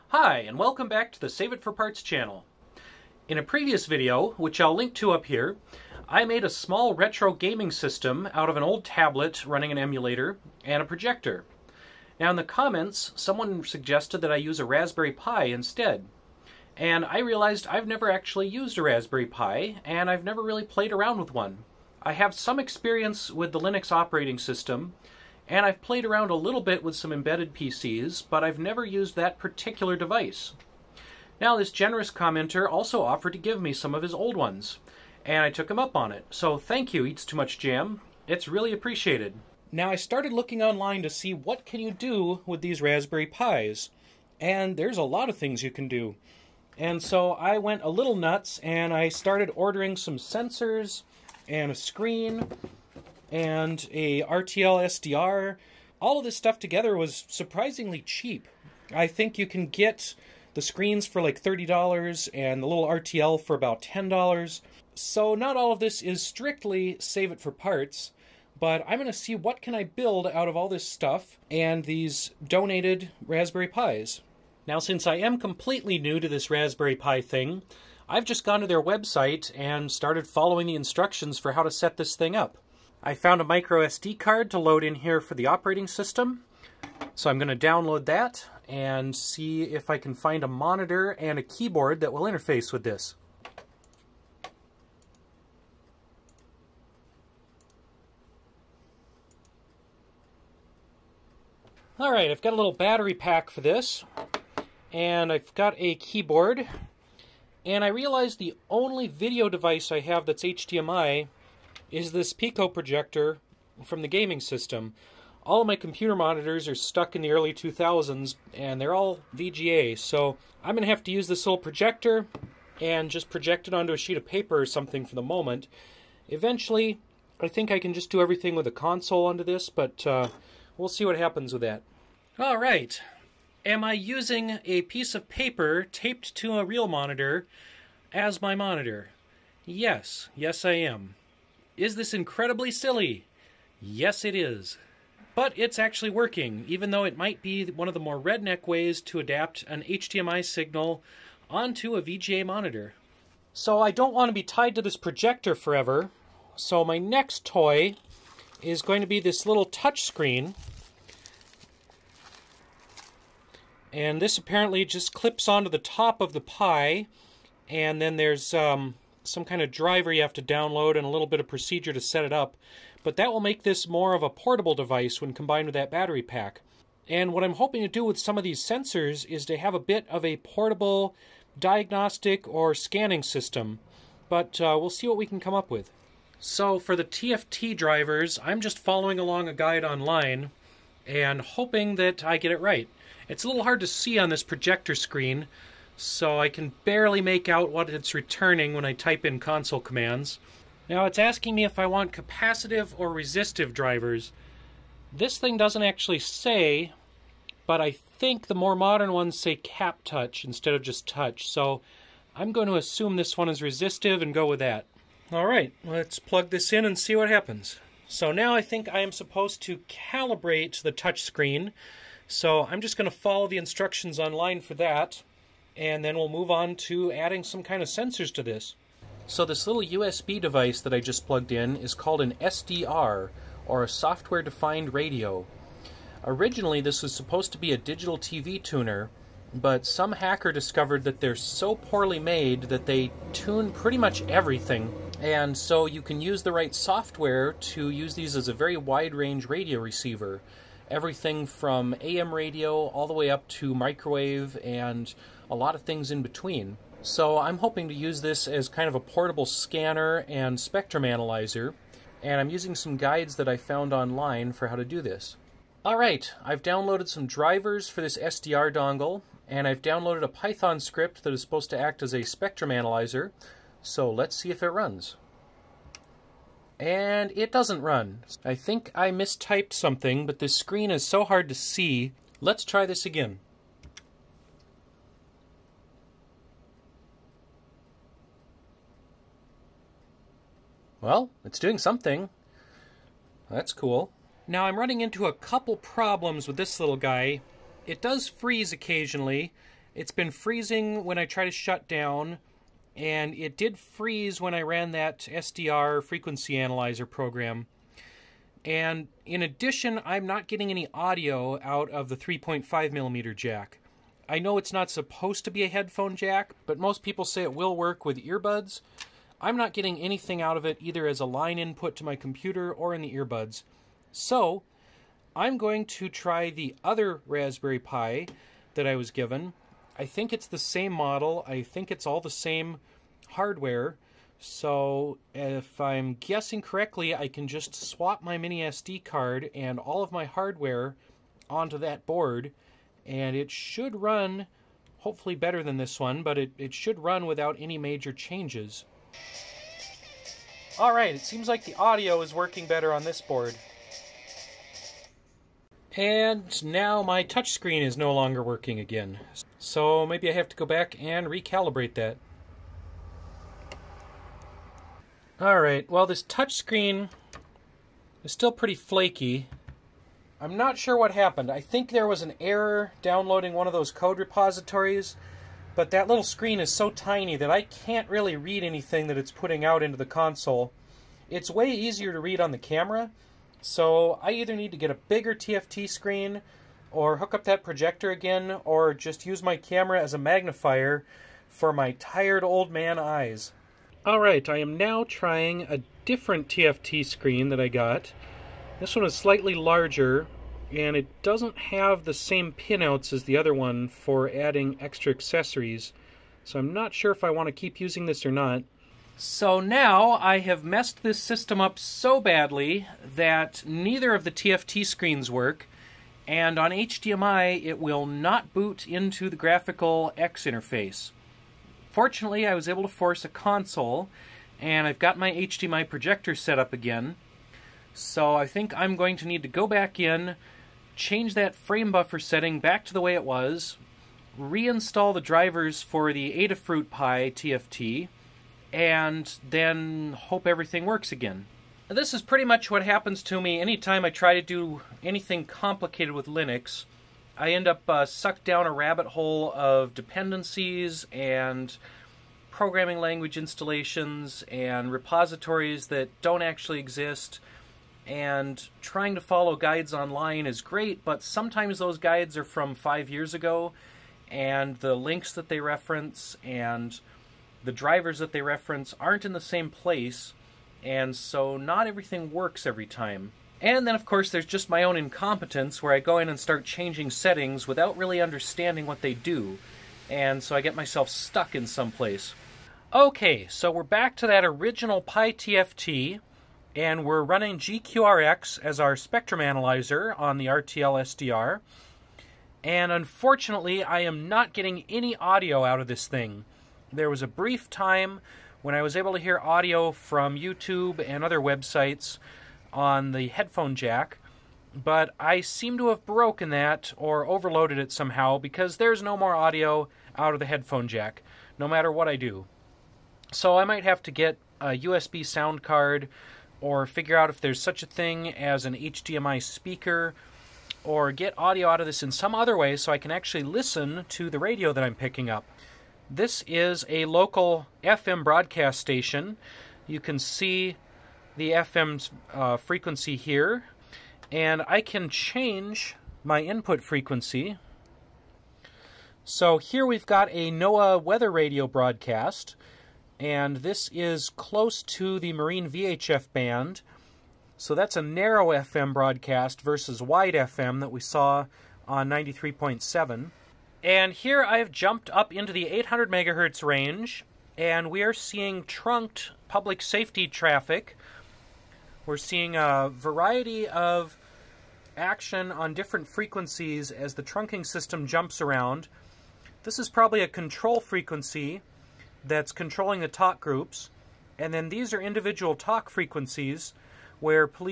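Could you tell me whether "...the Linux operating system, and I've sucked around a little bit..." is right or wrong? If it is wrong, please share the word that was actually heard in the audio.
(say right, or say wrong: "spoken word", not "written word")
wrong: "played", not "sucked".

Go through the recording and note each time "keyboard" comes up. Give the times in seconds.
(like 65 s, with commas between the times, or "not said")
91 s, 105 s.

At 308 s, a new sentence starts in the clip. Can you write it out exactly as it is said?
And in addition, I'm not getting any audio out of the 3.5 millimeter jack.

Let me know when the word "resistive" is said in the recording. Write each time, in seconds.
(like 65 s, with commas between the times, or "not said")
203 s, 213 s.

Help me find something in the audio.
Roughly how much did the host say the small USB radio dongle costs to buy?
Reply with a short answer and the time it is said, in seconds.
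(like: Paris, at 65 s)
$10, at 63 s.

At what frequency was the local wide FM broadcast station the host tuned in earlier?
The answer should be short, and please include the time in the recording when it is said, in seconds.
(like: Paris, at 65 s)
93.7, at 552 s.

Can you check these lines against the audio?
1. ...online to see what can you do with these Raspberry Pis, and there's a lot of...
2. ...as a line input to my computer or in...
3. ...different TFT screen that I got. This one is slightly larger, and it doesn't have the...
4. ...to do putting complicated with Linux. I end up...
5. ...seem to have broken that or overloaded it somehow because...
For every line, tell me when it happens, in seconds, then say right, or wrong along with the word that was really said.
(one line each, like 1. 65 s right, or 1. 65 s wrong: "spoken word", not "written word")
1. 40 s right
2. 321 s right
3. 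396 s right
4. 444 s wrong: "anything", not "putting"
5. 505 s right.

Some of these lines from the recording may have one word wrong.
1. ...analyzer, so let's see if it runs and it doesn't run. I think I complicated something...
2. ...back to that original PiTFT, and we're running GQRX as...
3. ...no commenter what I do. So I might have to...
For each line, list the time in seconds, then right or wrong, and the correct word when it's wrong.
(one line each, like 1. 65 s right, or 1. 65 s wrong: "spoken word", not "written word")
1. 272 s wrong: "mistyped", not "complicated"
2. 483 s right
3. 511 s wrong: "matter", not "commenter".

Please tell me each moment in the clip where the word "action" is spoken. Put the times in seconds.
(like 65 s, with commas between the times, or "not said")
564 s.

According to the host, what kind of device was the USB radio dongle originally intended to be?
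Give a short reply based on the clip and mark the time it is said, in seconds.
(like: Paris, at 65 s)
digital TV tuner, at 237 s.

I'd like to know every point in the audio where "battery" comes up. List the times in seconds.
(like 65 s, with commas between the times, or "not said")
102 s, 175 s.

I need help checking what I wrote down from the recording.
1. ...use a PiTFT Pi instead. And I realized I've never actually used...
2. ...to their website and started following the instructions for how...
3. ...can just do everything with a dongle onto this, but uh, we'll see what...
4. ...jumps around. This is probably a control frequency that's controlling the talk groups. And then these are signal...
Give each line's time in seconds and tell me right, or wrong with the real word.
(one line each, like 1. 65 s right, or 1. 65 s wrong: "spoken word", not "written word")
1. 14 s wrong: "Raspberry", not "PiTFT"
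2. 78 s right
3. 127 s wrong: "console", not "dongle"
4. 568 s wrong: "individual", not "signal".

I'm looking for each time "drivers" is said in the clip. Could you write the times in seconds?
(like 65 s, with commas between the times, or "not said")
169 s, 187 s, 203 s, 267 s, 435 s, 467 s.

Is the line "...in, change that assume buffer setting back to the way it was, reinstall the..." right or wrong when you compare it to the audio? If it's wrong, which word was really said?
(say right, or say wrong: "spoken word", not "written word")
wrong: "frame", not "assume".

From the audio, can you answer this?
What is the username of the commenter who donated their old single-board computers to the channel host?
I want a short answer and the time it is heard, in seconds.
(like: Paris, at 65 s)
Eats Too Much Jam, at 37 s.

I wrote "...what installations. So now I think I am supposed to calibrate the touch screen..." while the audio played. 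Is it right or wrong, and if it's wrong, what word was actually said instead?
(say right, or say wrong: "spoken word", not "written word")
wrong: "happens", not "installations".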